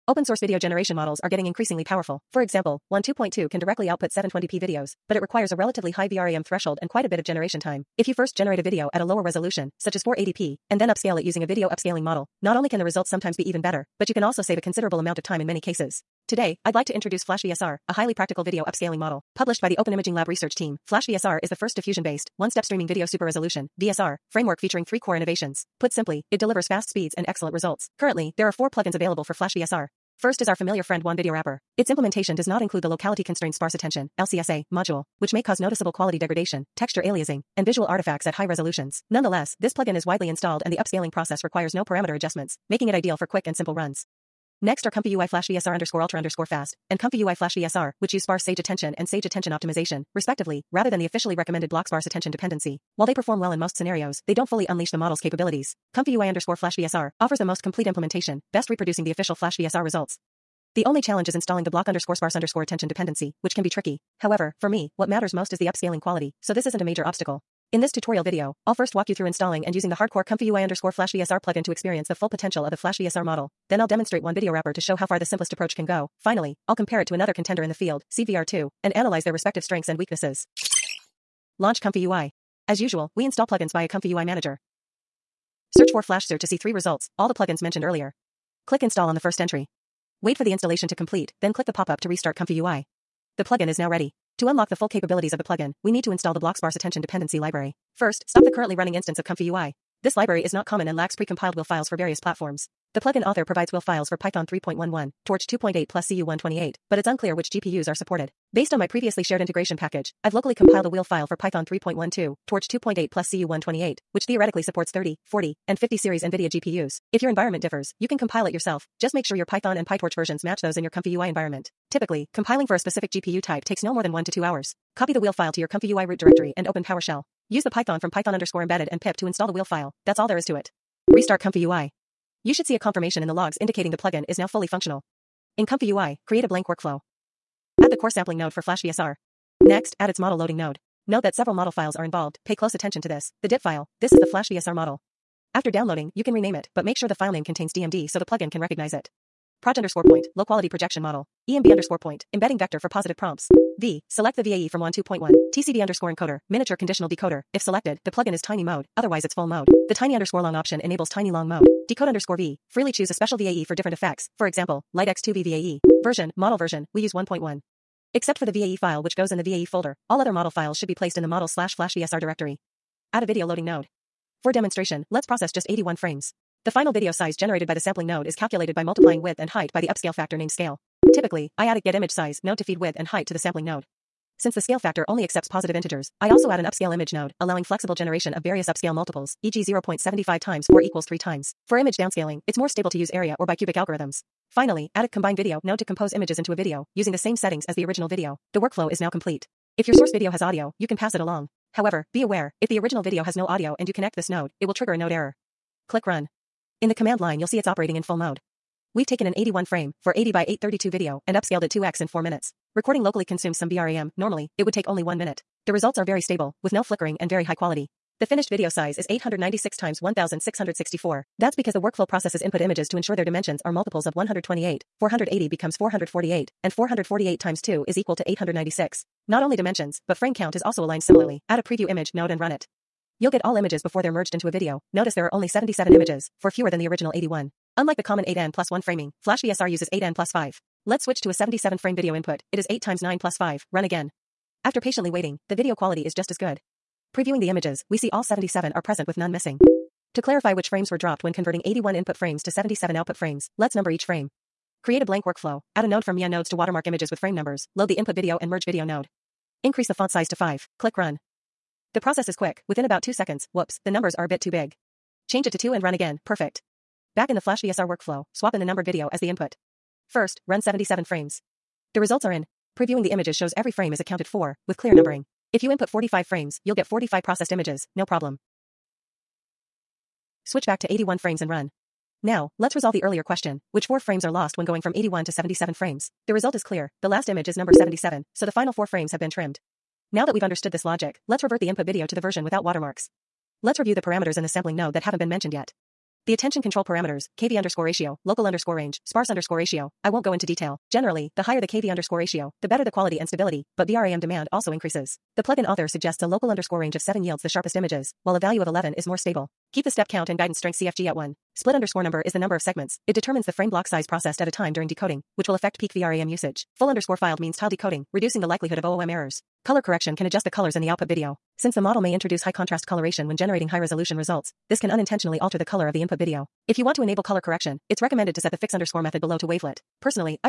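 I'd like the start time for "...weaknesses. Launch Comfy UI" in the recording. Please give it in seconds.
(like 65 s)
79 s.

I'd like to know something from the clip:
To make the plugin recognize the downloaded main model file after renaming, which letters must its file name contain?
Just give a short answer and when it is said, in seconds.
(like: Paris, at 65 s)
DMD, at 147 s.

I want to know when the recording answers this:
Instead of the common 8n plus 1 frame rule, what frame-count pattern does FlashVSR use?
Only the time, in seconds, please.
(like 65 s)
239 s.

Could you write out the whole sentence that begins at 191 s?
For image downscaling, it's more stable to use area or bicubic algorithms.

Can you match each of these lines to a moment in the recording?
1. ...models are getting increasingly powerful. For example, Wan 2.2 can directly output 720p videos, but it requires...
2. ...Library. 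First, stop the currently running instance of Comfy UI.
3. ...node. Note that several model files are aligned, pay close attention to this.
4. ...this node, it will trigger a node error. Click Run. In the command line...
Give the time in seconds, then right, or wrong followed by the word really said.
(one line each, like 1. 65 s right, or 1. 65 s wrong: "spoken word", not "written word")
1. 0 s right
2. 97 s right
3. 140 s wrong: "involved", not "aligned"
4. 204 s right.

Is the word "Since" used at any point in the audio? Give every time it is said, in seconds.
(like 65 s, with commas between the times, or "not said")
184 s, 321 s.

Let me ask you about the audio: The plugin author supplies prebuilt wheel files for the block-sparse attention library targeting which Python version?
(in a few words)
Python 3.11.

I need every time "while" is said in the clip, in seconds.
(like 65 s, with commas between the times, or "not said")
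52 s, 308 s.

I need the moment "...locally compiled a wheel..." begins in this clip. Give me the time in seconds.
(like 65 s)
110 s.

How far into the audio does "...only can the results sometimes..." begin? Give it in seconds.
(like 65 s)
12 s.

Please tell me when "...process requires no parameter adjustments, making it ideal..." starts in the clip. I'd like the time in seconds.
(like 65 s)
41 s.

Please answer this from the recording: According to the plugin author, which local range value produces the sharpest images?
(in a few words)
7.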